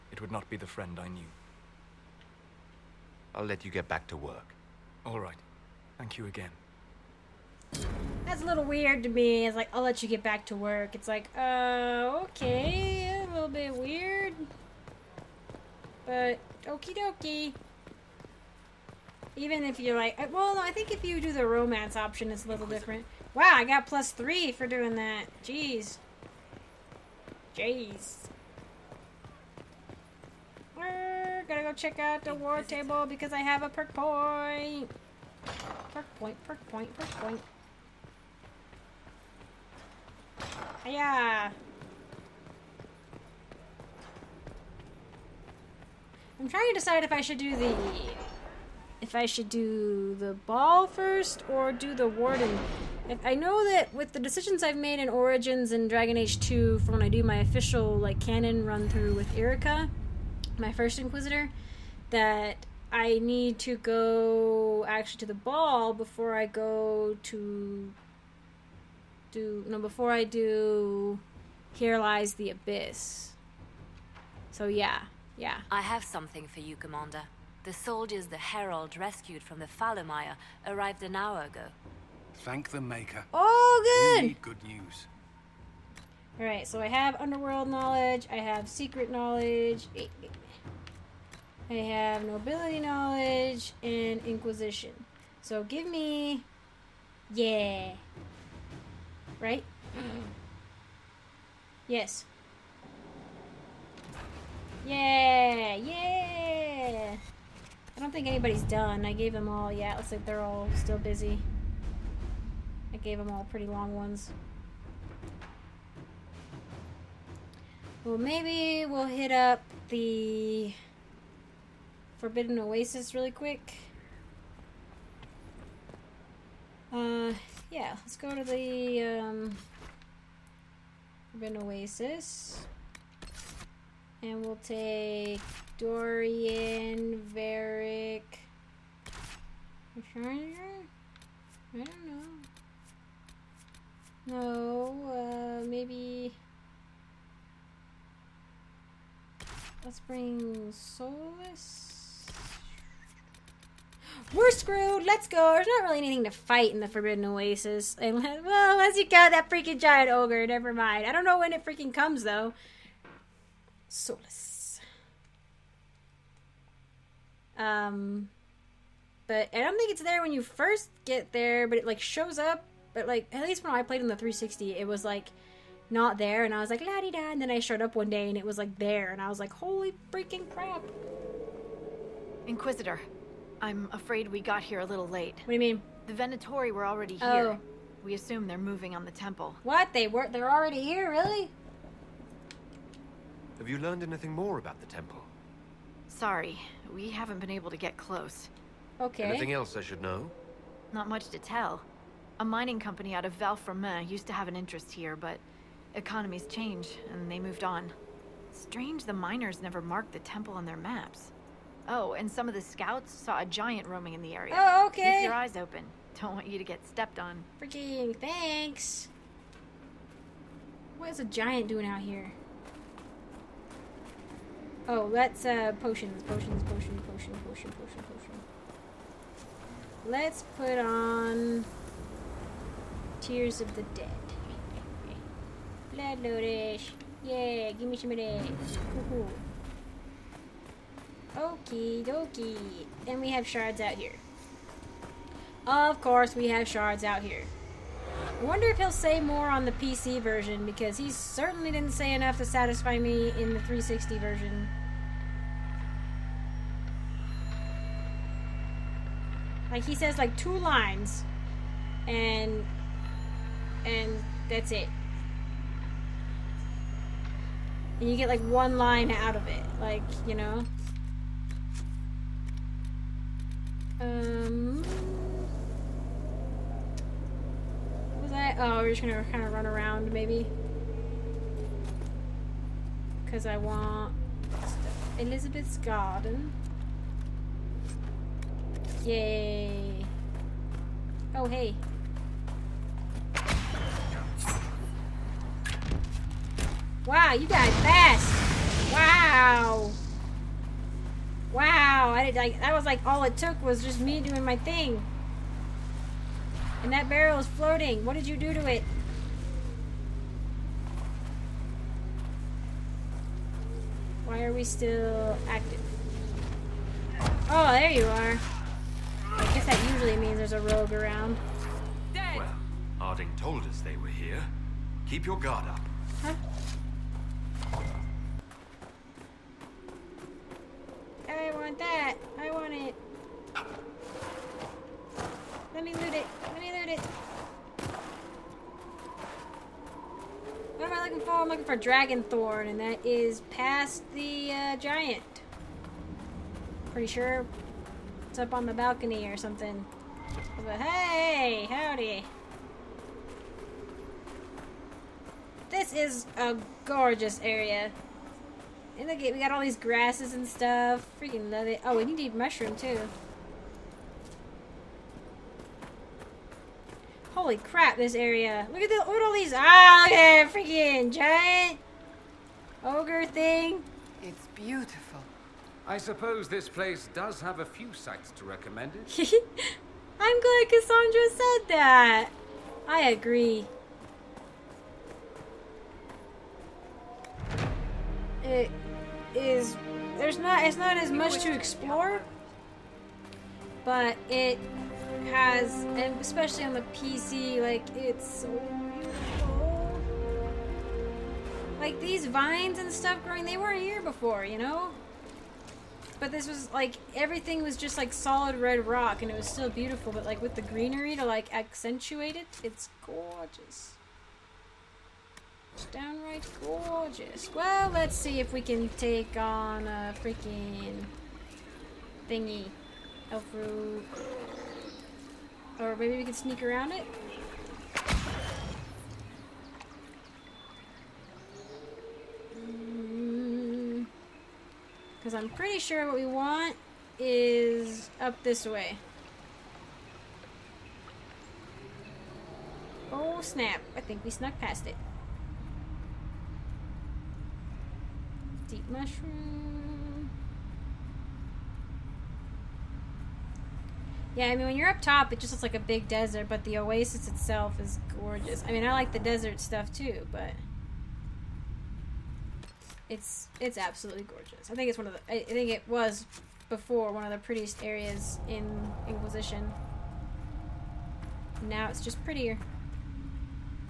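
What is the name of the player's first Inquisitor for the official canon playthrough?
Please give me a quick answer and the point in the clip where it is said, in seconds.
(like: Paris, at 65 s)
Erika, at 59 s.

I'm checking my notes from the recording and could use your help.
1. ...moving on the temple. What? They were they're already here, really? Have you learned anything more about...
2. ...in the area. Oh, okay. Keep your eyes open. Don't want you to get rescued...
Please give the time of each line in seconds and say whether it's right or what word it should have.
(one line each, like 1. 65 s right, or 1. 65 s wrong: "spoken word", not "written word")
1. 188 s right
2. 214 s wrong: "stepped", not "rescued".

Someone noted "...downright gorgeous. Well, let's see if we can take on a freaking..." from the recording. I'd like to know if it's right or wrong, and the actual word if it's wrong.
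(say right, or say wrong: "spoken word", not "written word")
right.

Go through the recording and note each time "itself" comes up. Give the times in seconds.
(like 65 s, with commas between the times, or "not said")
457 s.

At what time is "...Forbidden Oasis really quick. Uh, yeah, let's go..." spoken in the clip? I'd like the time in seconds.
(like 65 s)
122 s.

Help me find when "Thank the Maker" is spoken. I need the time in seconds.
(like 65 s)
82 s.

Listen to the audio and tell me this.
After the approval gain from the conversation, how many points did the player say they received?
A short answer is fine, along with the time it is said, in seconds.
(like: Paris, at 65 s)
3, at 23 s.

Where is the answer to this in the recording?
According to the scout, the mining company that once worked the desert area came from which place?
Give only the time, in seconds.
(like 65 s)
203 s.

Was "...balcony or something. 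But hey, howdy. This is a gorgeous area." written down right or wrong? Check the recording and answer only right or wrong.
right.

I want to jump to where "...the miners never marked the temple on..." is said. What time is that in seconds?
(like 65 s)
209 s.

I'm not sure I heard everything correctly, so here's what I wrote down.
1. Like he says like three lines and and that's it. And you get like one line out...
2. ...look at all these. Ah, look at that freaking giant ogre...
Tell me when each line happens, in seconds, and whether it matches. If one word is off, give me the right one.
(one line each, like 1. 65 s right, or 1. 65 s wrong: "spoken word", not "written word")
1. 259 s wrong: "two", not "three"
2. 368 s right.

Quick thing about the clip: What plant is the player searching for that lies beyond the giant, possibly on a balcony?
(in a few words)
Dragon Thorn.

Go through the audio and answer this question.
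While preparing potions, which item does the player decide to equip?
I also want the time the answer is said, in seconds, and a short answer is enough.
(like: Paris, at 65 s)
Tears of the Dead, at 233 s.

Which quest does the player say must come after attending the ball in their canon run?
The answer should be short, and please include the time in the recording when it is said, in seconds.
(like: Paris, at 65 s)
Here Lies the Abyss, at 71 s.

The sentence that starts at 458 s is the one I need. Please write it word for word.
I mean, I like the desert stuff too, but it's it's absolutely gorgeous.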